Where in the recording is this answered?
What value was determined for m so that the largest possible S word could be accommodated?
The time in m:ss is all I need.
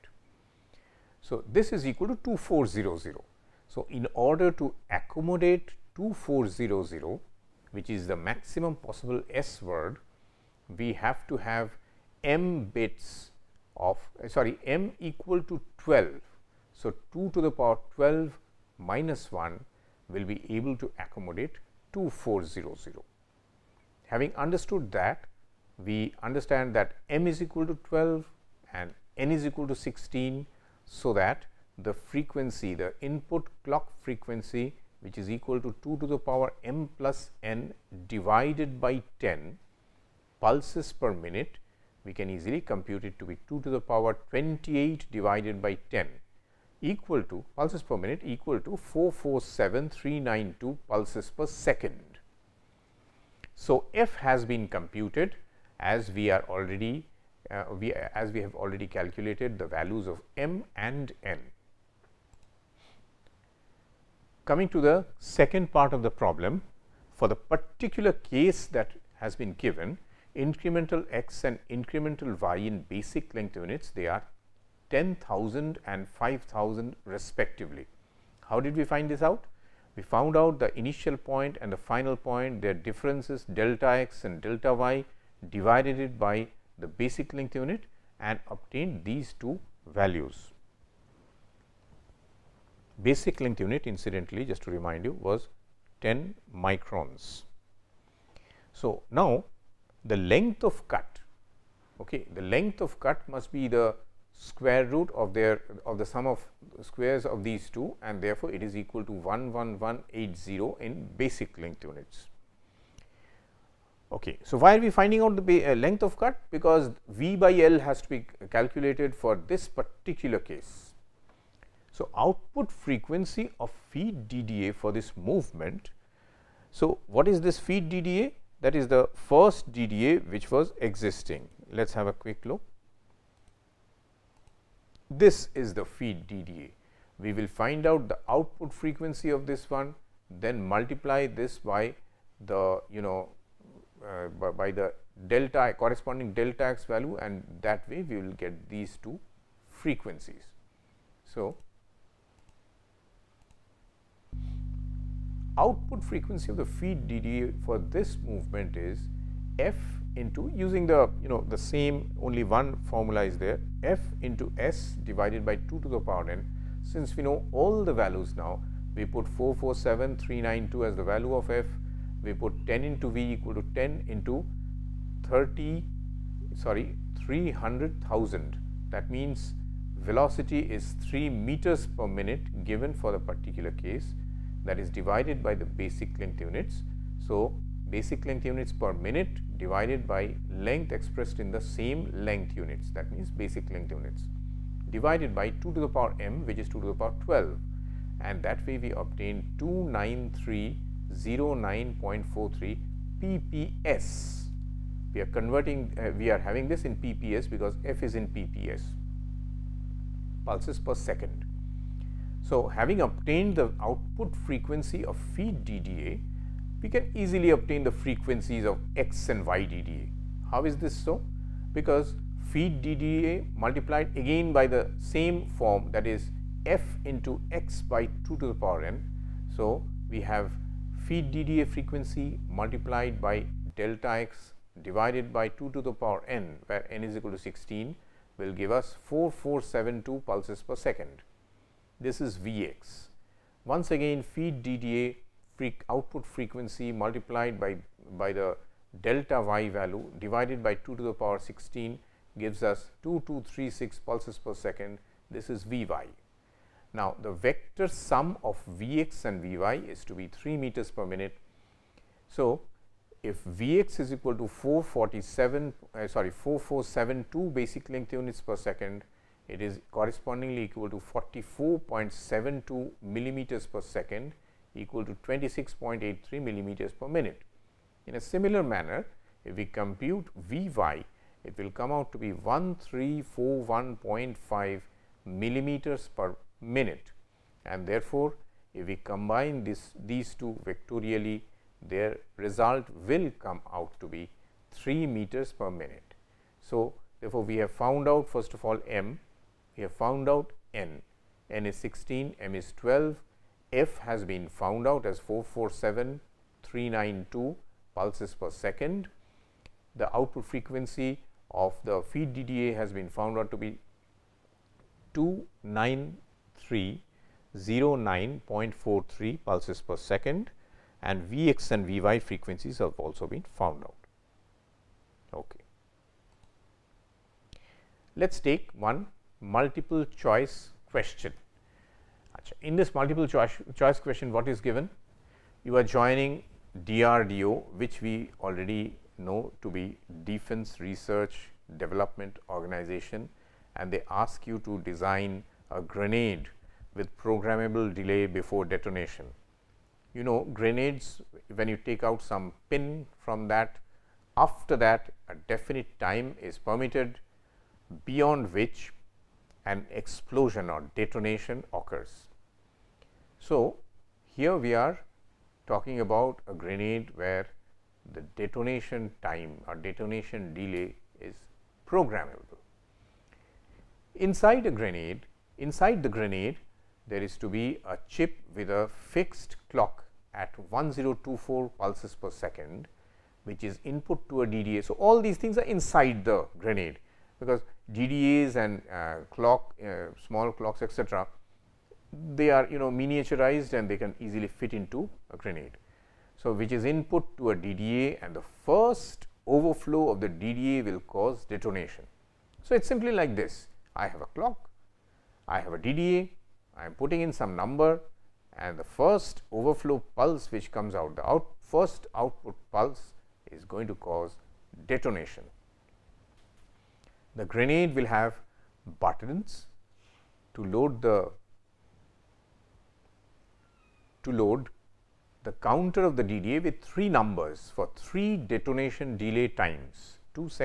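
0:14.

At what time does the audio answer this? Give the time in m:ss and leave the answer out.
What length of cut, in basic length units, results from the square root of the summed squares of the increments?
1:49.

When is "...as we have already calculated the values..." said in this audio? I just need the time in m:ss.
0:57.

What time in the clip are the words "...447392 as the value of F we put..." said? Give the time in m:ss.
2:49.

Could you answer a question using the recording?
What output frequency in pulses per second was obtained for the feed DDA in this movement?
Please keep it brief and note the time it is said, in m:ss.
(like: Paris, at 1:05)
29309.43 pps, at 3:19.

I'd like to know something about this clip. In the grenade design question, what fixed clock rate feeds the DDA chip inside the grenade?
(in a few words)
1024 pulses per second.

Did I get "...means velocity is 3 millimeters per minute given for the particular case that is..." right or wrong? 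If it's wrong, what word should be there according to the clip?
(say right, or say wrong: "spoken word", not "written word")
wrong: "meters", not "millimeters".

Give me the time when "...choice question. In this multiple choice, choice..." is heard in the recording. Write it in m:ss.
5:30.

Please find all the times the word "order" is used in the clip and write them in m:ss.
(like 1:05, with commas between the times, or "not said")
0:04.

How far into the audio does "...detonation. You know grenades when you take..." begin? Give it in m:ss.
5:48.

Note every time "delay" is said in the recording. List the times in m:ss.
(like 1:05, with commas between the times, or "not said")
5:47, 6:10, 7:09.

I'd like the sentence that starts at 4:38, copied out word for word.
In a similar manner, if we compute V y, it will come out to be 1341.5 millimeters per minute.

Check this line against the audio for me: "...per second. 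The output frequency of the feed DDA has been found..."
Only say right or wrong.
right.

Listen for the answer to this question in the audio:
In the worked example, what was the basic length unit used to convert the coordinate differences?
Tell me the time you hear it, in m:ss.
1:36.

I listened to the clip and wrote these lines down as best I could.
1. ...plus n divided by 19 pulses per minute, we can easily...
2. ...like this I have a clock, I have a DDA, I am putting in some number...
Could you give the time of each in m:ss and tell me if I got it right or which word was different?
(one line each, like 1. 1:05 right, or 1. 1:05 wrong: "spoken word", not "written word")
1. 0:36 wrong: "10", not "19"
2. 6:43 right.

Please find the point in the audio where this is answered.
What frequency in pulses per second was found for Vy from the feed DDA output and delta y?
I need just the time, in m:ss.
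4:13.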